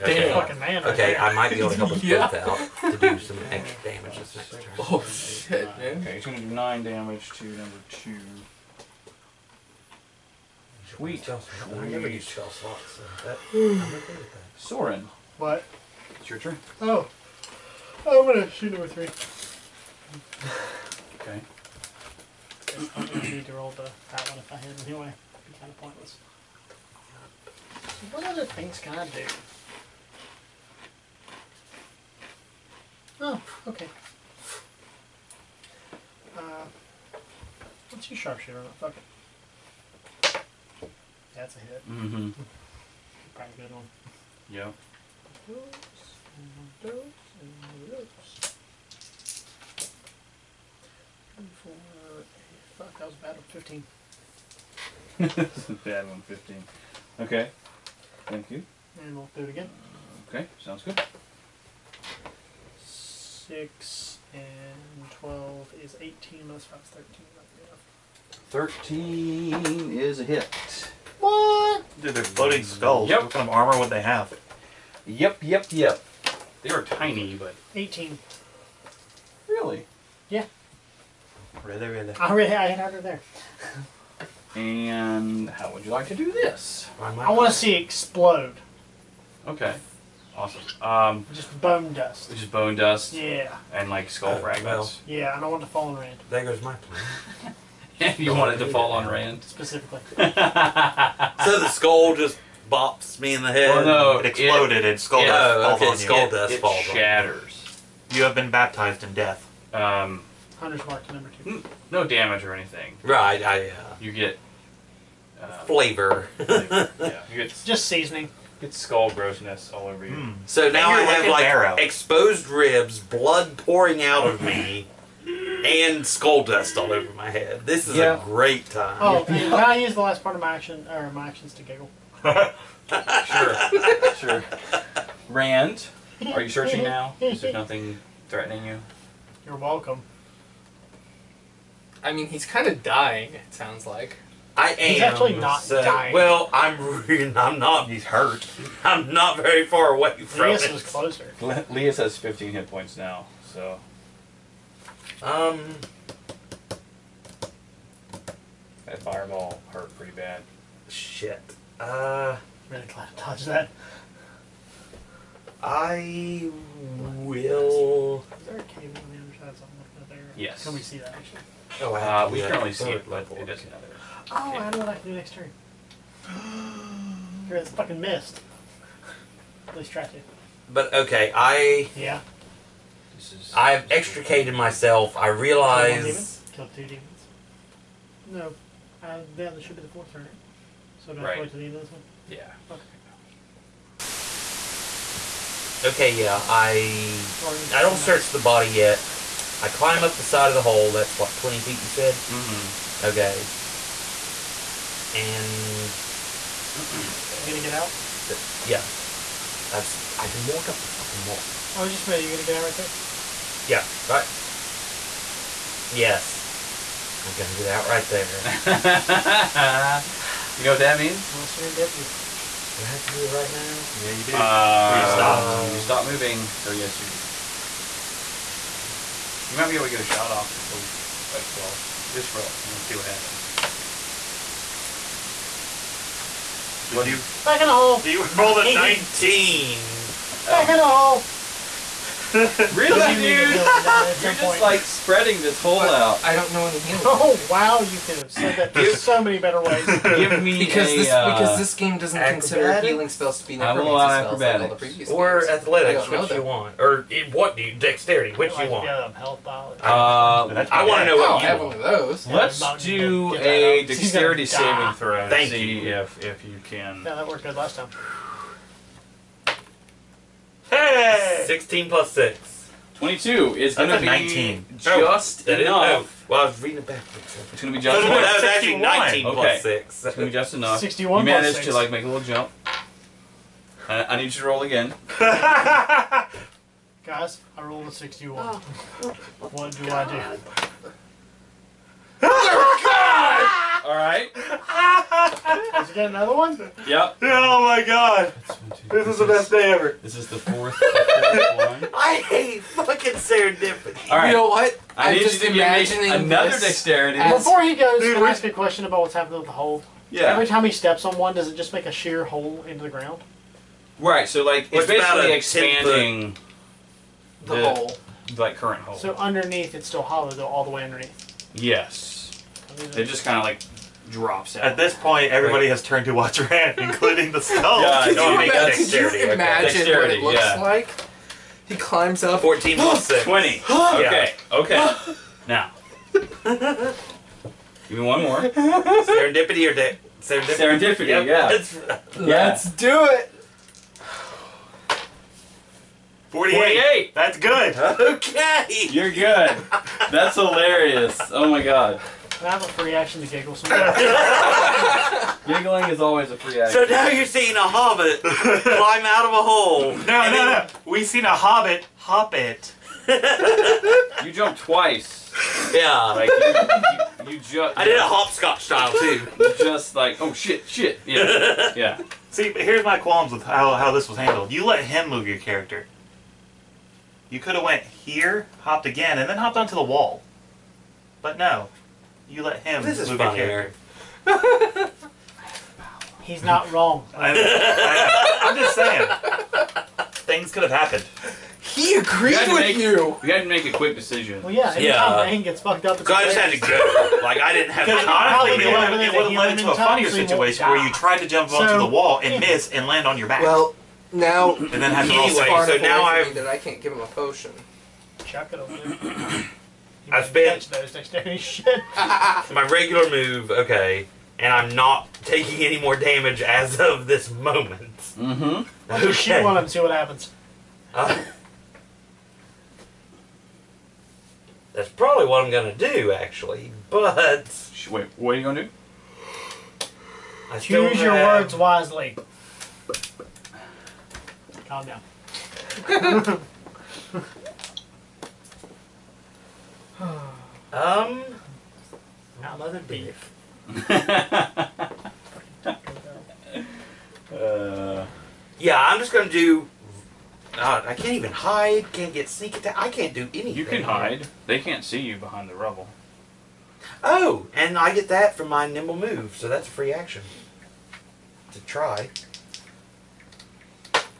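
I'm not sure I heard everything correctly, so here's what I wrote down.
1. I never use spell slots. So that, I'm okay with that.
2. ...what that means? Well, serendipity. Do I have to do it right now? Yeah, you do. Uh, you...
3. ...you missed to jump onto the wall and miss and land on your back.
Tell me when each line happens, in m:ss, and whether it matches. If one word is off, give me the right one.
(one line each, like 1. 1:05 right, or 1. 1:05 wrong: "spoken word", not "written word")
1. 0:11 right
2. 3:40 right
3. 6:40 wrong: "tried", not "missed".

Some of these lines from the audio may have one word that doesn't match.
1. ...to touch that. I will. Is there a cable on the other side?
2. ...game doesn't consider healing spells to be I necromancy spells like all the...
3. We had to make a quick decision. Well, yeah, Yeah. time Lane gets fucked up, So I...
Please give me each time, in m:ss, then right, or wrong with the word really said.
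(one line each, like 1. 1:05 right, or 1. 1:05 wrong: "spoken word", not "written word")
1. 2:43 right
2. 4:11 right
3. 6:33 right.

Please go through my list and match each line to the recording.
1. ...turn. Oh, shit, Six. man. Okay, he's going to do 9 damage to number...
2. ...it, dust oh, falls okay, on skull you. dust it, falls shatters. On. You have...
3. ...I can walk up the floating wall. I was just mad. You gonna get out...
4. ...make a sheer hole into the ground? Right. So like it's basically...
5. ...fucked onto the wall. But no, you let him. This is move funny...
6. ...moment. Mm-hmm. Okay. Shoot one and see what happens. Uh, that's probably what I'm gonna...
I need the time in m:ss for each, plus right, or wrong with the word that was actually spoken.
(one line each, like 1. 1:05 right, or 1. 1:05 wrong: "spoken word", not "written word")
1. 0:04 wrong: "Nine", not "Six"
2. 1:45 right
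3. 3:30 wrong: "fucking", not "floating"
4. 5:11 right
5. 6:19 wrong: "hopped", not "fucked"
6. 6:57 right.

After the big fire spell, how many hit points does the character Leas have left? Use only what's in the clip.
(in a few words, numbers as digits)
15.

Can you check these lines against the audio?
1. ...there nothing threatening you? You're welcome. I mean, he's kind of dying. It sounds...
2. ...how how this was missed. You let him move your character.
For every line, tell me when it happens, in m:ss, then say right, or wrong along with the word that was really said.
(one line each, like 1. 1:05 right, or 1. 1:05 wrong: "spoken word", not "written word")
1. 2:17 right
2. 6:13 wrong: "handled", not "missed".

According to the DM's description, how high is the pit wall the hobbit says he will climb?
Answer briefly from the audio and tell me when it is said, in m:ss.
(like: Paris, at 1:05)
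Twenty feet, at 3:21.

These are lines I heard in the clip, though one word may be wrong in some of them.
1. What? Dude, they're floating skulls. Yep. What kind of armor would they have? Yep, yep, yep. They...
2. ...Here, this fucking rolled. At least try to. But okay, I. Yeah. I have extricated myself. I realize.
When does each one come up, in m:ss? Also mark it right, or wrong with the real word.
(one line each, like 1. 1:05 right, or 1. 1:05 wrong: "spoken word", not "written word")
1. 1:11 right
2. 2:57 wrong: "missed", not "rolled".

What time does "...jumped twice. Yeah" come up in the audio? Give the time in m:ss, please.
6:04.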